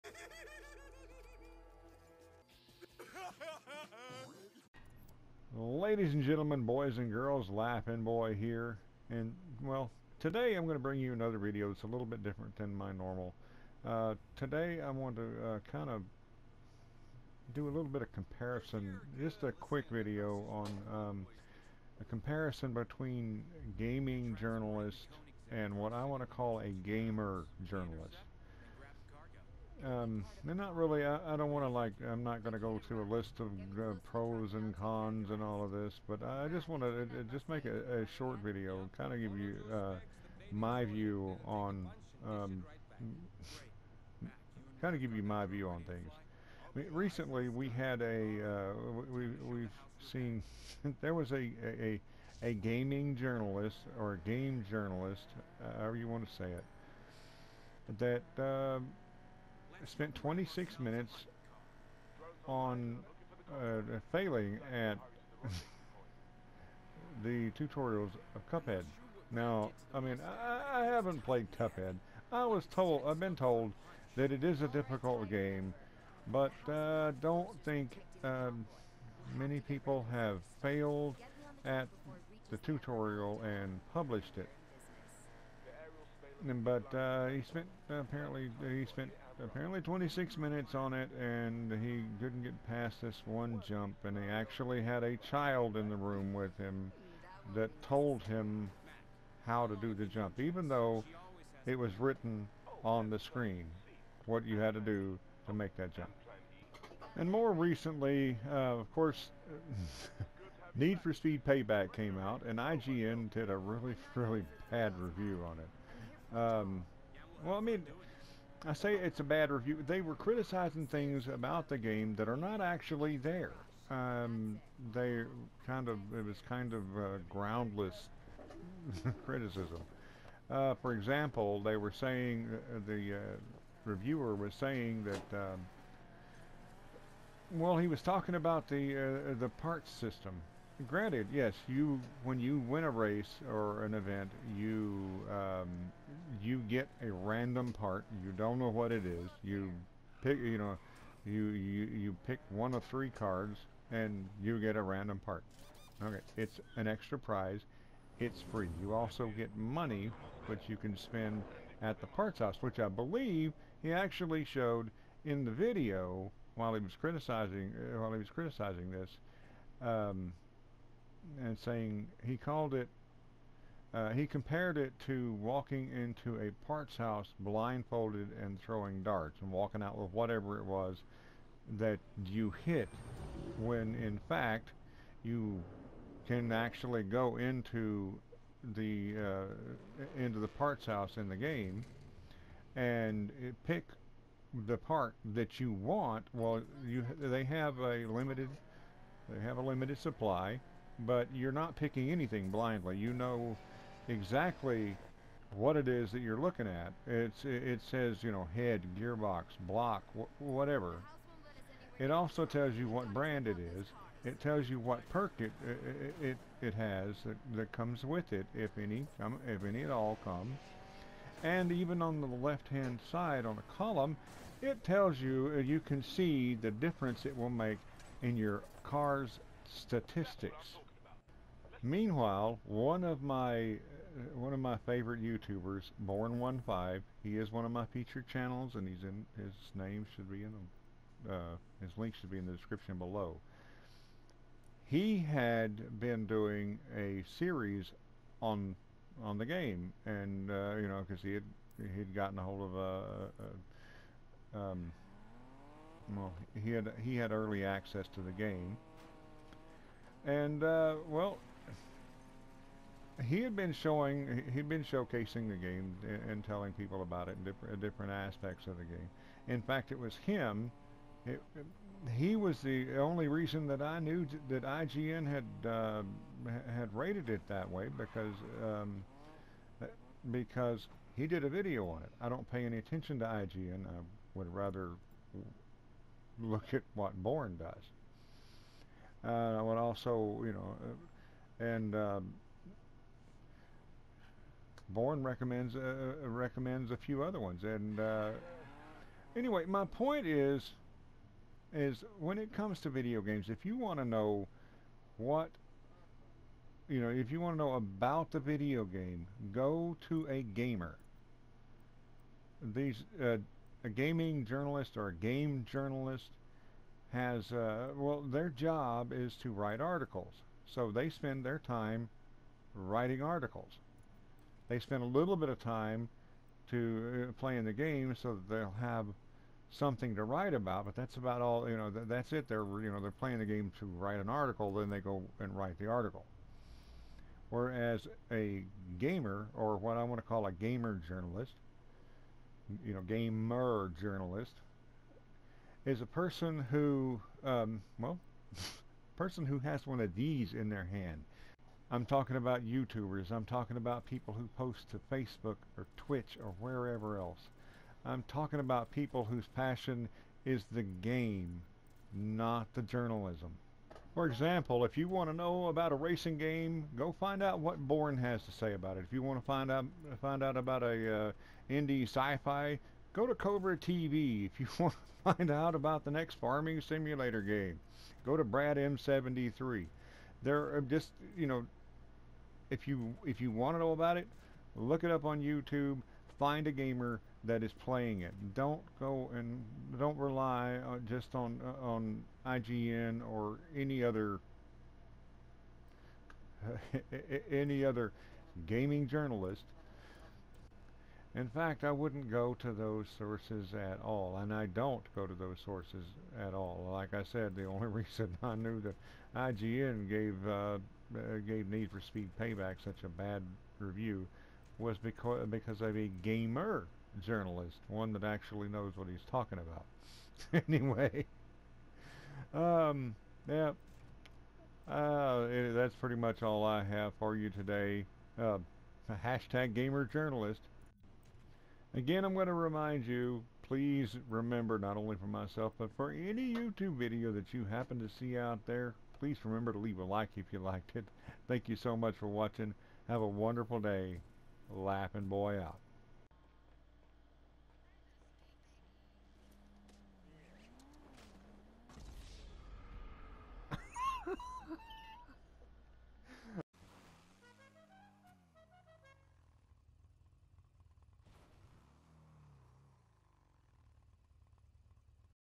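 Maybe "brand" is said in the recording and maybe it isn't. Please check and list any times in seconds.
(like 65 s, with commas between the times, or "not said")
213 s.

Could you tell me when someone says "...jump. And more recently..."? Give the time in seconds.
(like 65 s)
105 s.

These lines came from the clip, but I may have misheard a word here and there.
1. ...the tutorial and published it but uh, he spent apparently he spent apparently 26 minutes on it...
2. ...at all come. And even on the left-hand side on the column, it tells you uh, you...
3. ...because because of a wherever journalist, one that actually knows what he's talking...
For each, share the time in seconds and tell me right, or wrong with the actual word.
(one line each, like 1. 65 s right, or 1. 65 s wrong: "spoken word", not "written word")
1. 82 s right
2. 219 s right
3. 414 s wrong: "gamer", not "wherever".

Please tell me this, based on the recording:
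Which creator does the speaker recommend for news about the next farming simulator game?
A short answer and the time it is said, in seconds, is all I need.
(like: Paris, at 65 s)
Brad M73, at 378 s.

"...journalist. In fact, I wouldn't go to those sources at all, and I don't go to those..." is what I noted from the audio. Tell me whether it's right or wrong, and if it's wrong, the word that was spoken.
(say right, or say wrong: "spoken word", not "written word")
right.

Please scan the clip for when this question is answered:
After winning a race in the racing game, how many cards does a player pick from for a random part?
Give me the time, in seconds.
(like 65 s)
152 s.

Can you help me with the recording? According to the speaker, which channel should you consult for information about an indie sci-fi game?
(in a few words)
Cobra TV.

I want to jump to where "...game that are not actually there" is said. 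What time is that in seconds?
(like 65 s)
121 s.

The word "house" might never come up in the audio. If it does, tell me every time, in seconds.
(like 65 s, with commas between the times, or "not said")
162 s, 176 s, 190 s.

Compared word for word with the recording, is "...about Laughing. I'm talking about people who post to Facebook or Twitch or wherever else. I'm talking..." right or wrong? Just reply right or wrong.
wrong.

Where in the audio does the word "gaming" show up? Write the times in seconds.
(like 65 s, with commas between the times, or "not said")
23 s, 52 s, 313 s, 398 s.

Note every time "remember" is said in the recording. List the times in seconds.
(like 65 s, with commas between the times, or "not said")
434 s, 439 s.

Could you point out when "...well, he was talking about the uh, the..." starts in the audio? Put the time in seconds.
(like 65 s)
137 s.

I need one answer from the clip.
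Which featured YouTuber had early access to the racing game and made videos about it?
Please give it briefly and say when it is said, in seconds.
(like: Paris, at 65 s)
Bourne15, at 236 s.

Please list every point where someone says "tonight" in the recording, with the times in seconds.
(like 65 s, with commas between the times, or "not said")
not said.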